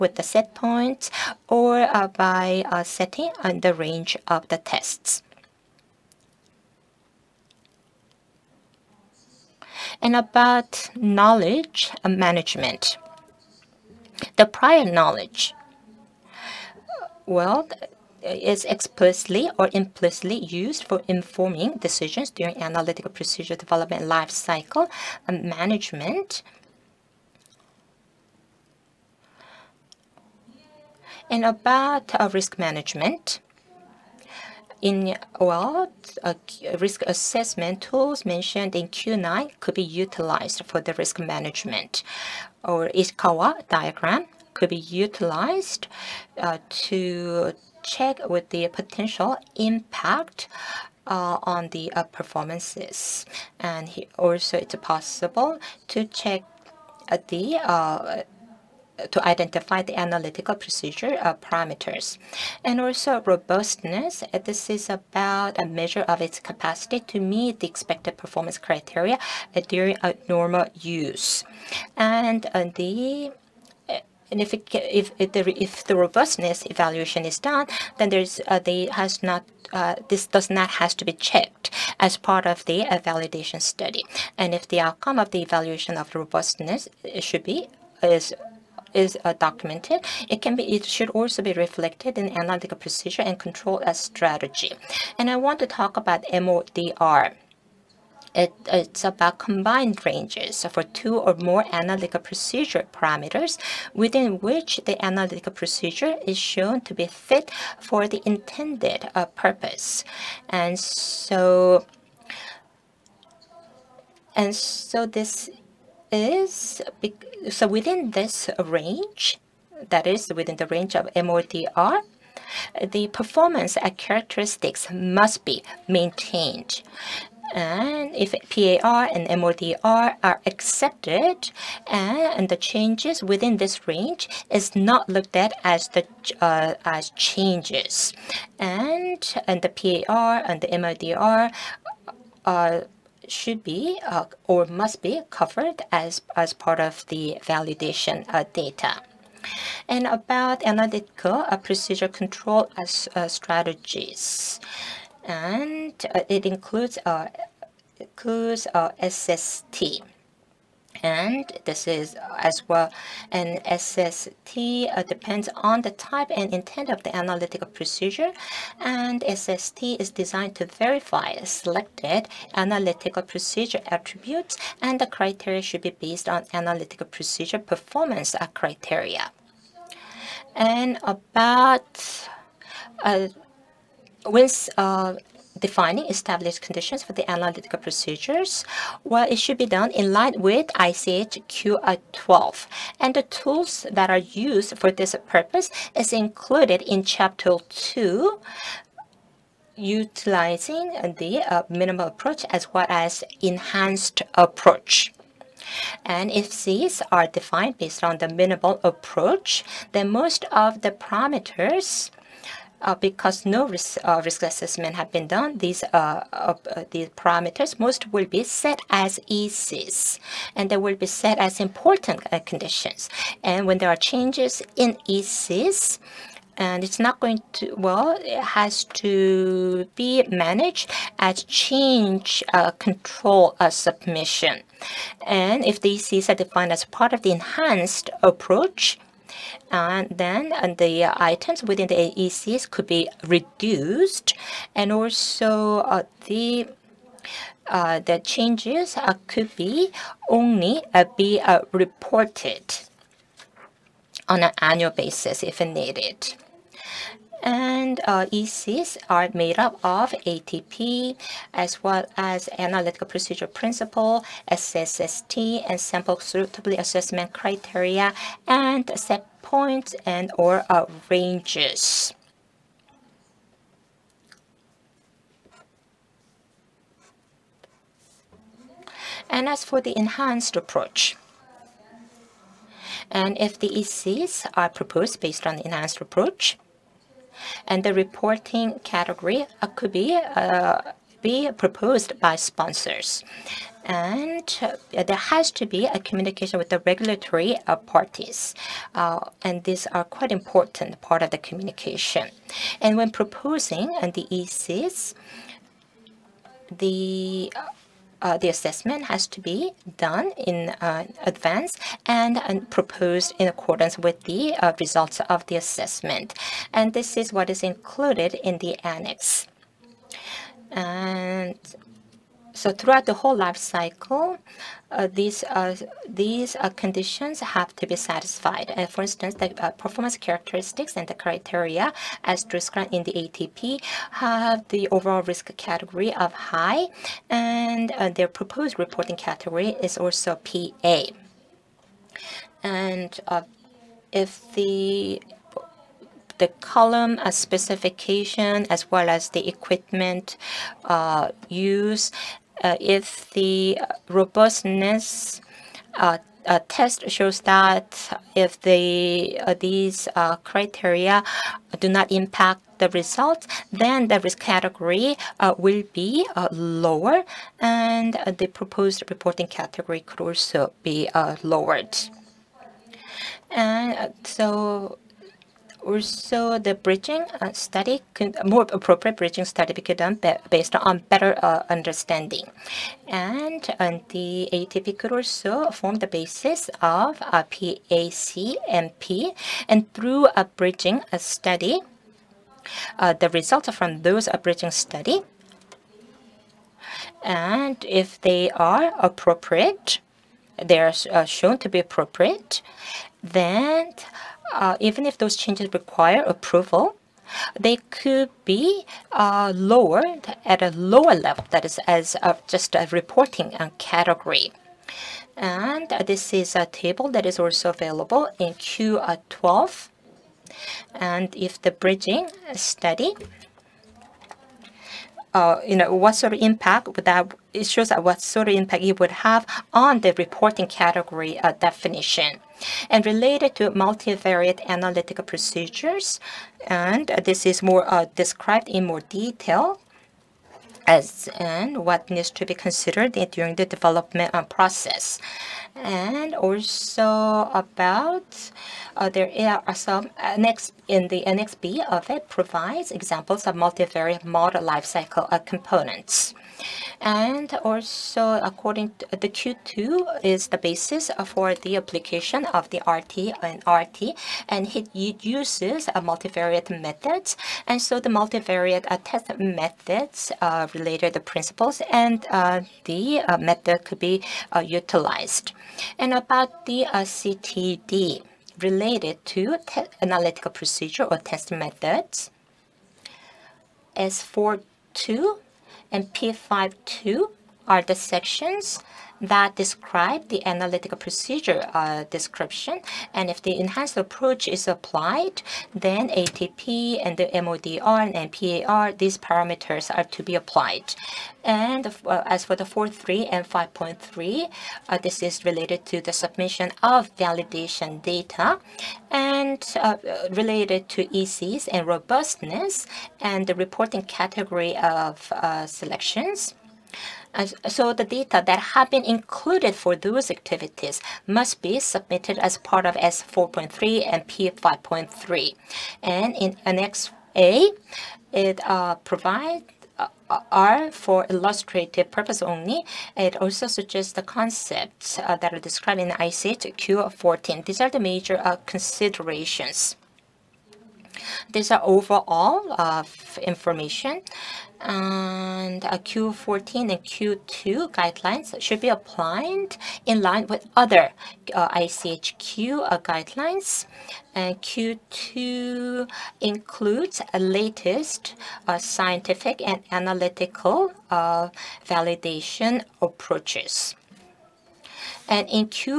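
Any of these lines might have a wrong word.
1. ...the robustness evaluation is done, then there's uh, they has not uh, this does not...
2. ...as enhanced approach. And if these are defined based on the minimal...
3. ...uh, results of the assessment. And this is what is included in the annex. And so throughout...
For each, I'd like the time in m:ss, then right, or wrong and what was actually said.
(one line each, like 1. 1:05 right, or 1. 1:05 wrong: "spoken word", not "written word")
1. 1:15 right
2. 3:22 right
3. 5:14 right.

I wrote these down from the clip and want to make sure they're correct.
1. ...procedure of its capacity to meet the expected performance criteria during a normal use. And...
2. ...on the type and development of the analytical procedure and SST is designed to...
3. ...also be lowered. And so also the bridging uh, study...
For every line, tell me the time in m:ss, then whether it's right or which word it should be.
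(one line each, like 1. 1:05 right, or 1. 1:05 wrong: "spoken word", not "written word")
1. 1:05 wrong: "measure", not "procedure"
2. 2:45 wrong: "intent", not "development"
3. 6:10 right.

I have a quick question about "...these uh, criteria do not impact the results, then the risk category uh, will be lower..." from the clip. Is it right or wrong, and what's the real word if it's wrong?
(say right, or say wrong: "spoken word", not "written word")
right.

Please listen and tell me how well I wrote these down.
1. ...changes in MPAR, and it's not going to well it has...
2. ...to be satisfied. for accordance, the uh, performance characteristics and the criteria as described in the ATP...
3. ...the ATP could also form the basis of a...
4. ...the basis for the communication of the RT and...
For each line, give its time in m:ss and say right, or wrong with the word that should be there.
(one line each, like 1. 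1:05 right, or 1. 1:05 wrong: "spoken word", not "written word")
1. 3:43 wrong: "ECs", not "MPAR"
2. 5:27 wrong: "instance", not "accordance"
3. 6:24 right
4. 7:40 wrong: "application", not "communication".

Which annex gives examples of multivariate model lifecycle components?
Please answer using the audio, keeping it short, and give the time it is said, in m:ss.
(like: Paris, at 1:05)
Annex B, at 7:31.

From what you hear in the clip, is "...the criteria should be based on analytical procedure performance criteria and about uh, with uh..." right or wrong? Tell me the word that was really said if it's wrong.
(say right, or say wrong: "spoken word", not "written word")
right.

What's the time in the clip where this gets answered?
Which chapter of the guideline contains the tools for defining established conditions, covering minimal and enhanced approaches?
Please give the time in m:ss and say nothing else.
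3:17.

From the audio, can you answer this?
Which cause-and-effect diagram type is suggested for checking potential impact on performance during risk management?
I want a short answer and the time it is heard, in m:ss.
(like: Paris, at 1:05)
Ishikawa diagram, at 0:42.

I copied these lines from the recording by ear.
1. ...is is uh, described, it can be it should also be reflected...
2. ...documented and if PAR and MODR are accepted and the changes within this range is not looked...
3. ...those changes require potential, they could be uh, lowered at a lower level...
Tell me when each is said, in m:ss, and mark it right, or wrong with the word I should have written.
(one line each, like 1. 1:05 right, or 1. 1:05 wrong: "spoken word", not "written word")
1. 1:28 wrong: "documented", not "described"
2. 2:05 wrong: "maintained", not "documented"
3. 6:45 wrong: "approval", not "potential".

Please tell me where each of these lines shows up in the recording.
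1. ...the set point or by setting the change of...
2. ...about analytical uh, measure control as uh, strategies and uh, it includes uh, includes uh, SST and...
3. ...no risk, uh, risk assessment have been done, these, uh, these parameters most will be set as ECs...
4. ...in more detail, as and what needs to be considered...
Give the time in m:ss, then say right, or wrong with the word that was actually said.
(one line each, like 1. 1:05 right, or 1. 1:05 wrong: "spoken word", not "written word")
1. 0:00 wrong: "range", not "change"
2. 2:30 wrong: "procedure", not "measure"
3. 3:33 right
4. 7:18 right.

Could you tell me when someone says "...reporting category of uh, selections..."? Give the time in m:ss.
8:33.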